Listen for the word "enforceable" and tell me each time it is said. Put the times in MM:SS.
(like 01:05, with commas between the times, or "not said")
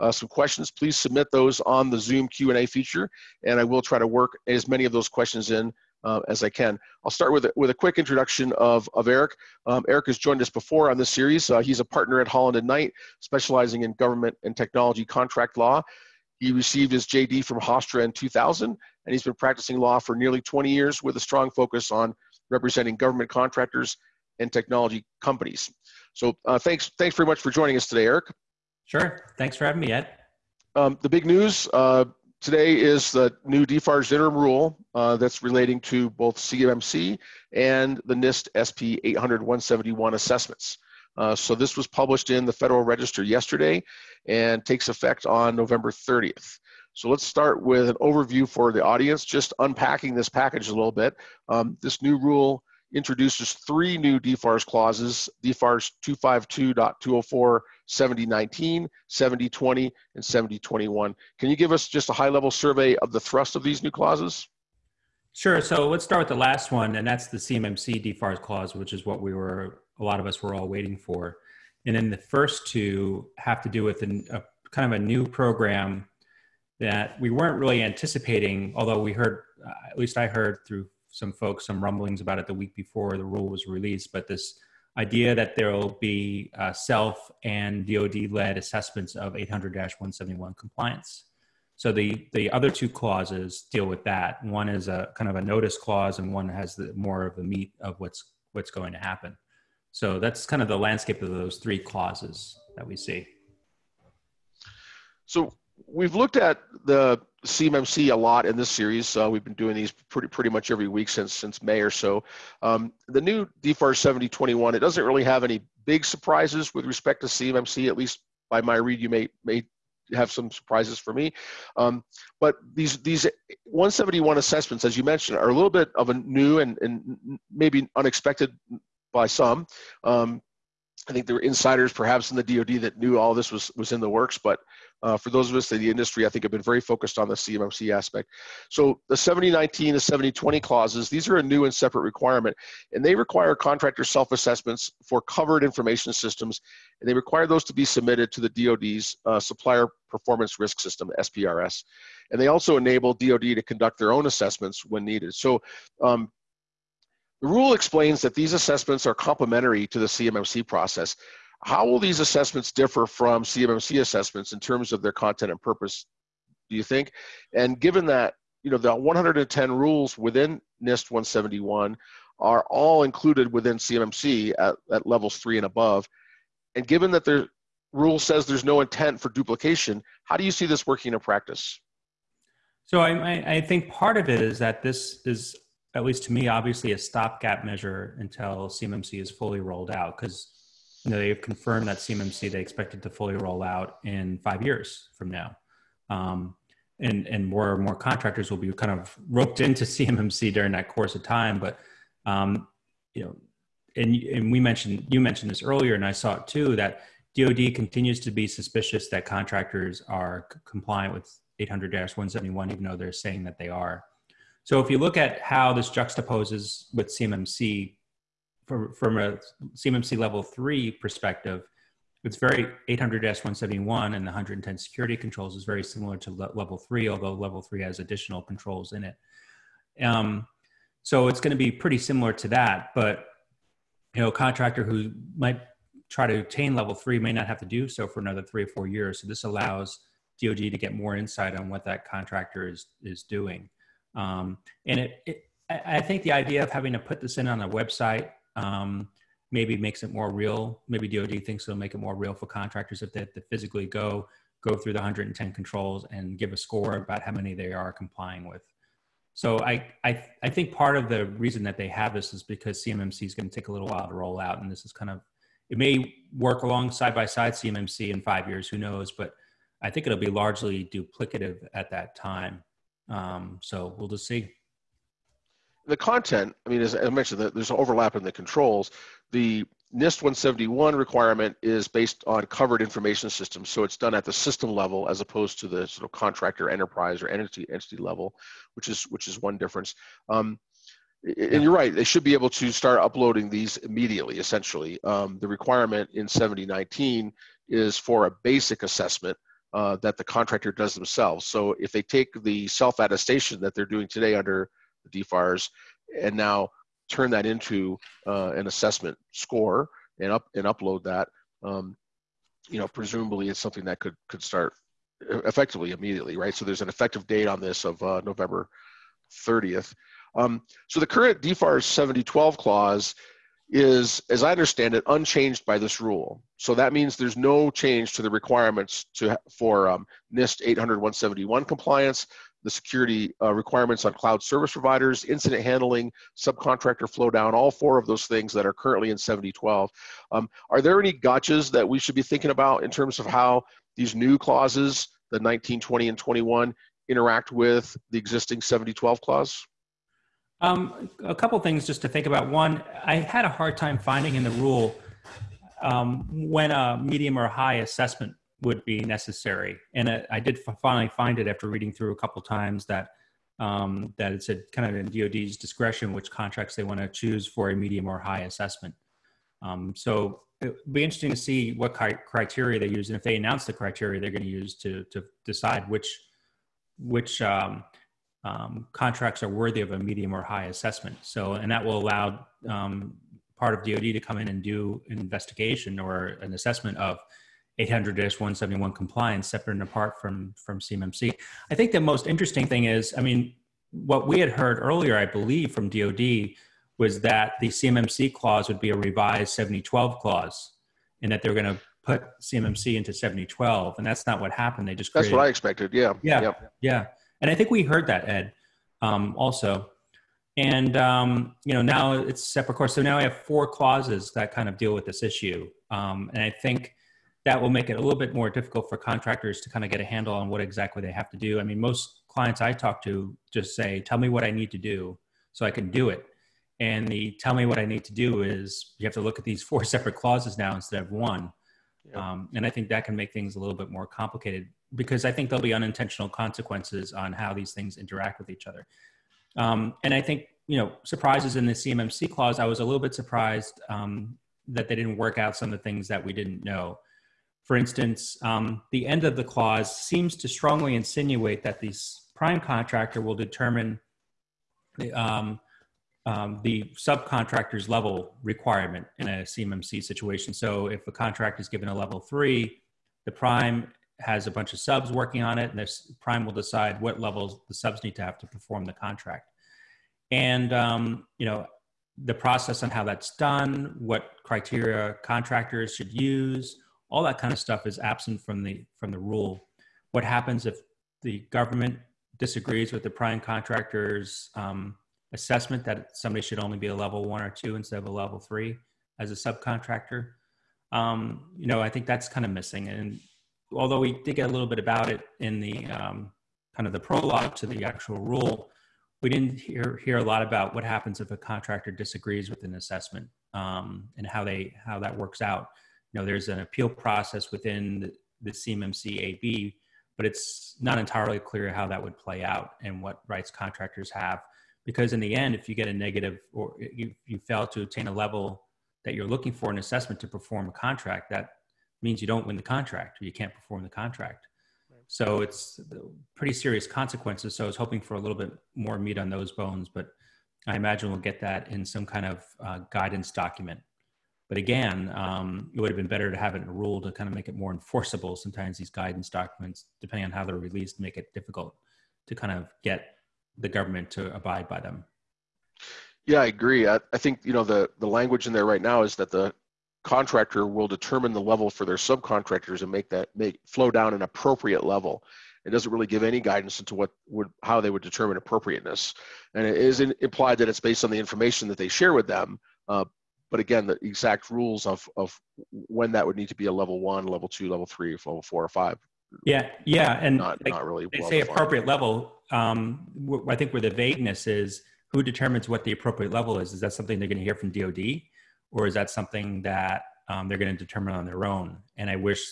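08:57.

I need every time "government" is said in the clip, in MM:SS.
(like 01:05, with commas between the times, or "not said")
00:13, 00:22, 08:01, 09:03.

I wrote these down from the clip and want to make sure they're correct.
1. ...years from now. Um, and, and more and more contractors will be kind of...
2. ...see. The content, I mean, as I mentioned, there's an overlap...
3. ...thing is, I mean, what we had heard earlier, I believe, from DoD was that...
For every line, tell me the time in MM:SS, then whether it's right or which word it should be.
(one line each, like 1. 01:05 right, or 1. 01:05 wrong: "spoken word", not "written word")
1. 03:14 right
2. 04:34 right
3. 06:32 right.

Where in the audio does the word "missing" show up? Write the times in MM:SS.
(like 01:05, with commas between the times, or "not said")
08:12.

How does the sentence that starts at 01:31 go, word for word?
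So the, the other two clauses deal with that.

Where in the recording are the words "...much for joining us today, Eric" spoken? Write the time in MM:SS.
00:27.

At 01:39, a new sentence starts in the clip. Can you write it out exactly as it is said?
So that's kind of the landscape of those three clauses that we see.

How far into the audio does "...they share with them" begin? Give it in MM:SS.
09:21.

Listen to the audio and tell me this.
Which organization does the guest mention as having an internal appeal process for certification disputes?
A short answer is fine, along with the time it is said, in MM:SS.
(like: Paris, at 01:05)
CMMC AB, at 08:28.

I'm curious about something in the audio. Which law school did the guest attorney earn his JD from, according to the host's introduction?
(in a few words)
Hofstra.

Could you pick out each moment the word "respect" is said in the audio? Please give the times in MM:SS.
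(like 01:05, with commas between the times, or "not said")
01:56.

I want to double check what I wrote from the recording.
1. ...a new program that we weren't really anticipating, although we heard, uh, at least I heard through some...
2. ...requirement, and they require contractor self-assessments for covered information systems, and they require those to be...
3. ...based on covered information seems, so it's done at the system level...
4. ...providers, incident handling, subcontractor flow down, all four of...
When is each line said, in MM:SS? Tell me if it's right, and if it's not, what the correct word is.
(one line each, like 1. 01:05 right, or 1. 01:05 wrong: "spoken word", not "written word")
1. 01:14 right
2. 02:22 right
3. 04:41 wrong: "systems", not "seems"
4. 05:34 right.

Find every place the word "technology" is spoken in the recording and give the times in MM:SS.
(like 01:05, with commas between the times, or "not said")
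00:14, 00:24.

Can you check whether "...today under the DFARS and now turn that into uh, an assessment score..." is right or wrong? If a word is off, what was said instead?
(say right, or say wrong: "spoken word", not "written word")
right.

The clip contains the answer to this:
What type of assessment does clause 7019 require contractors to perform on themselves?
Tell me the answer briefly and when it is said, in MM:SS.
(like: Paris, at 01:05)
basic assessment, at 04:58.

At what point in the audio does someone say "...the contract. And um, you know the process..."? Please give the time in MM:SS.
07:48.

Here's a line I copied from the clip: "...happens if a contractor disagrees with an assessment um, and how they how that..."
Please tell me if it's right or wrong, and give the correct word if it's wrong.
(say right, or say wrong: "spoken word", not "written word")
right.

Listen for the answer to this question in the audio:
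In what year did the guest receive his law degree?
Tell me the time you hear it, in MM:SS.
00:18.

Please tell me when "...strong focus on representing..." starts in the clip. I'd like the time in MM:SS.
00:21.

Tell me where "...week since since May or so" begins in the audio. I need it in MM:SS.
01:50.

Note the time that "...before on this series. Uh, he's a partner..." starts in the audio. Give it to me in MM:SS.
00:10.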